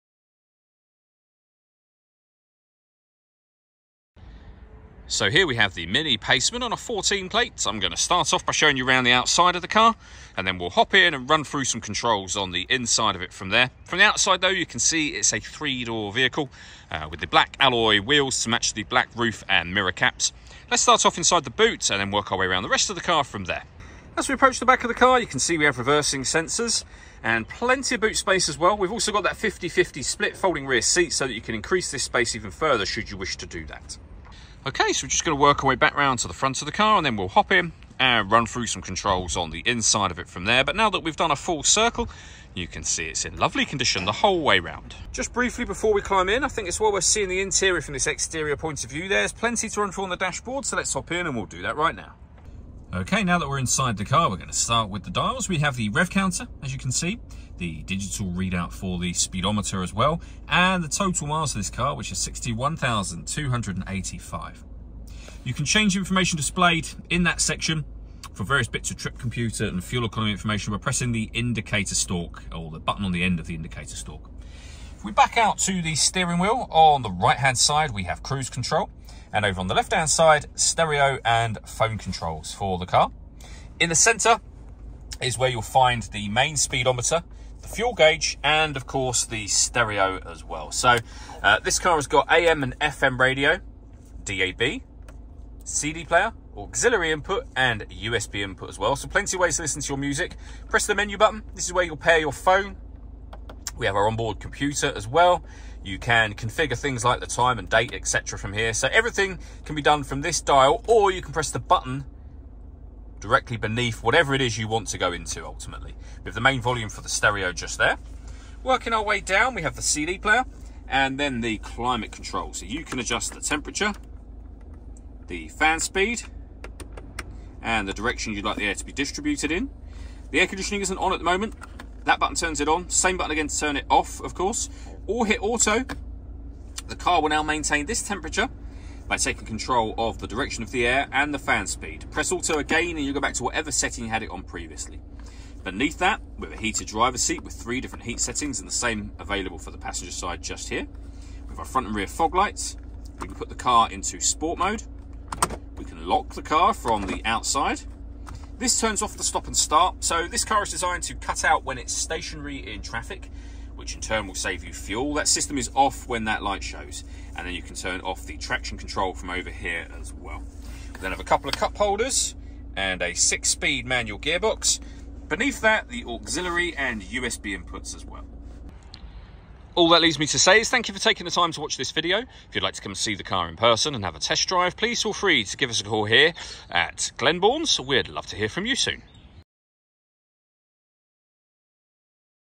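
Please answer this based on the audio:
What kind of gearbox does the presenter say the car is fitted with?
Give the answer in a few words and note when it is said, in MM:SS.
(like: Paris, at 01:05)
6-speed manual, at 02:53.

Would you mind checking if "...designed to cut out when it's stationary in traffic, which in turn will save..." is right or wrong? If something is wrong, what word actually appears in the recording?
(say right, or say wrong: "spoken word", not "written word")
right.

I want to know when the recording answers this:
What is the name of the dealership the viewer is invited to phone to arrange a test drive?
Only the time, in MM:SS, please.
03:07.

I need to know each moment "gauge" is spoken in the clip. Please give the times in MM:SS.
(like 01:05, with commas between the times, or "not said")
01:27.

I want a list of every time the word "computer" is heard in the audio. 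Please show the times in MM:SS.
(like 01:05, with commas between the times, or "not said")
01:09, 01:44.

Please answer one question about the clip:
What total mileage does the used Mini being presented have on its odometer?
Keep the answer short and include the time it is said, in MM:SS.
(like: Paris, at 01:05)
61,285, at 01:02.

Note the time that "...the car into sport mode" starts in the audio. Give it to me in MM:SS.
02:33.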